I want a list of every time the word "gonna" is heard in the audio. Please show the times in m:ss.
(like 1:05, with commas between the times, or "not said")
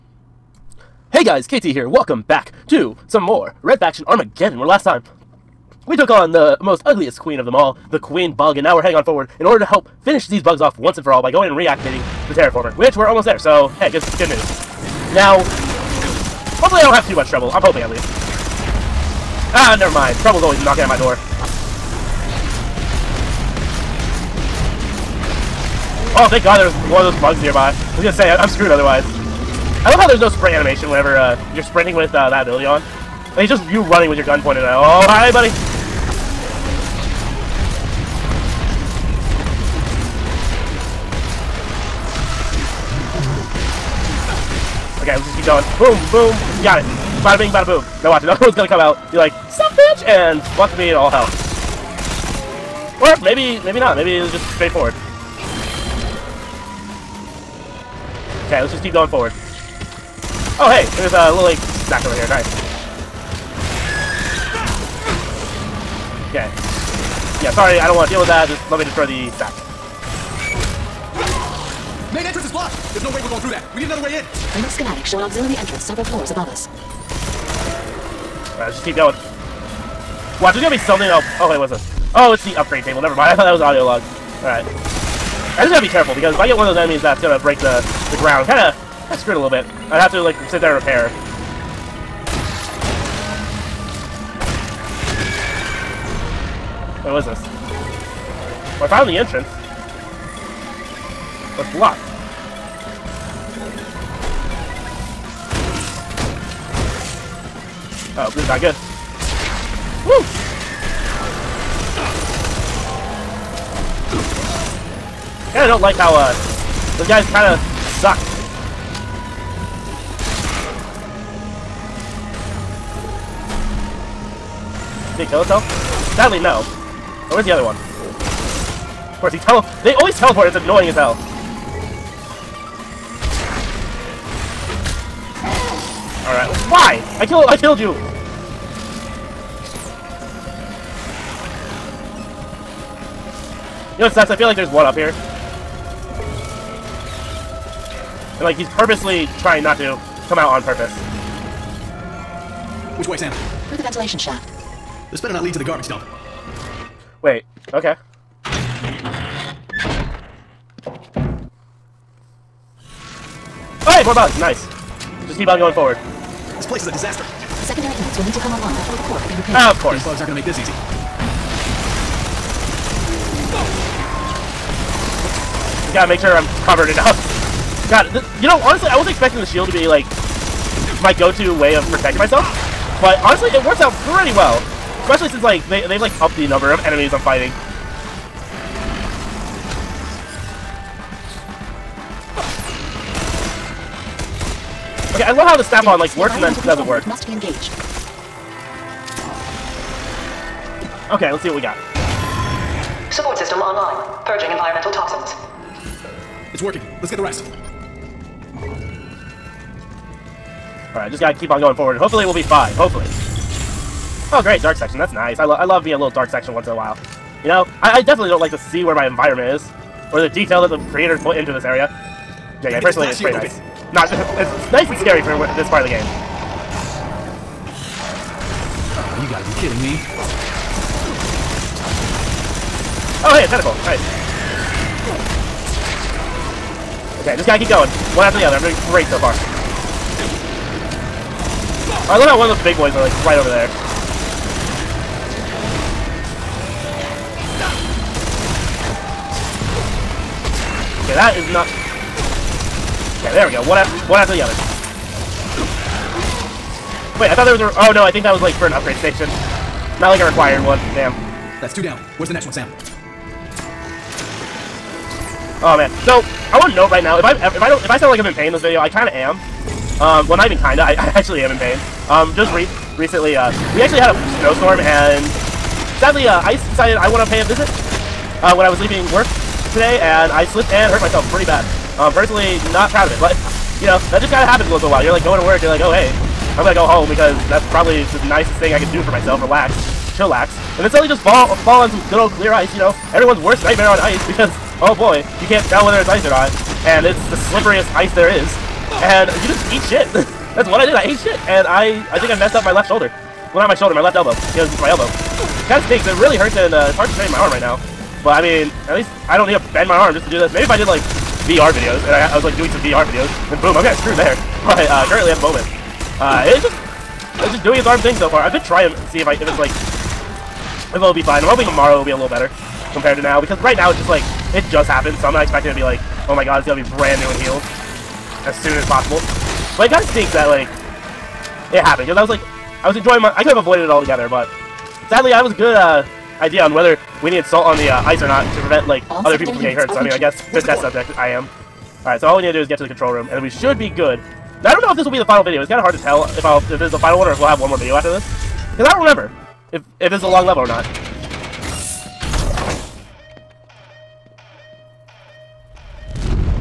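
0:28, 0:48, 1:20, 1:27, 5:26.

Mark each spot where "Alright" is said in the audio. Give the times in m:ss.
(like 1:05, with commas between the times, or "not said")
1:18, 1:24, 3:30, 5:42.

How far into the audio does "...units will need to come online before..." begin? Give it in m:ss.
2:47.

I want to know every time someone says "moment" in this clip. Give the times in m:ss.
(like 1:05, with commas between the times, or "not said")
5:15.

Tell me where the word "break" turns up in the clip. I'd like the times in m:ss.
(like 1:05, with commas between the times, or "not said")
1:27.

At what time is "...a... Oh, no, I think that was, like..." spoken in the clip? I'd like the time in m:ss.
4:17.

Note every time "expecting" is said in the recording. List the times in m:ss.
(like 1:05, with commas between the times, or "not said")
2:59, 5:25.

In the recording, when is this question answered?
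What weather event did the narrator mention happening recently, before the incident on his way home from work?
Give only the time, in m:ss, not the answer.
4:34.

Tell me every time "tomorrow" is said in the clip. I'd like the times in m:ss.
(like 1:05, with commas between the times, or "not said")
5:21.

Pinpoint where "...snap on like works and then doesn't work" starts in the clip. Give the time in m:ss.
3:15.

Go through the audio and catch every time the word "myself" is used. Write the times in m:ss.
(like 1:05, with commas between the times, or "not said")
3:02, 4:41, 4:49.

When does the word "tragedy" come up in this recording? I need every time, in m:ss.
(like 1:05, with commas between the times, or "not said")
not said.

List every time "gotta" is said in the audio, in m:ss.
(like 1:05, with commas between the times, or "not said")
1:25, 2:55, 3:31, 3:49, 3:57.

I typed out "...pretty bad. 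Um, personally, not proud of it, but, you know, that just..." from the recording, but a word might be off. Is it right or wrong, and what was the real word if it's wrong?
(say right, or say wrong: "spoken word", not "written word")
right.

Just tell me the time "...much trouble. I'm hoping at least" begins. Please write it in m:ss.
0:17.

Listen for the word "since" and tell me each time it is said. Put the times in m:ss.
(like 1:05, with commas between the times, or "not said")
3:05.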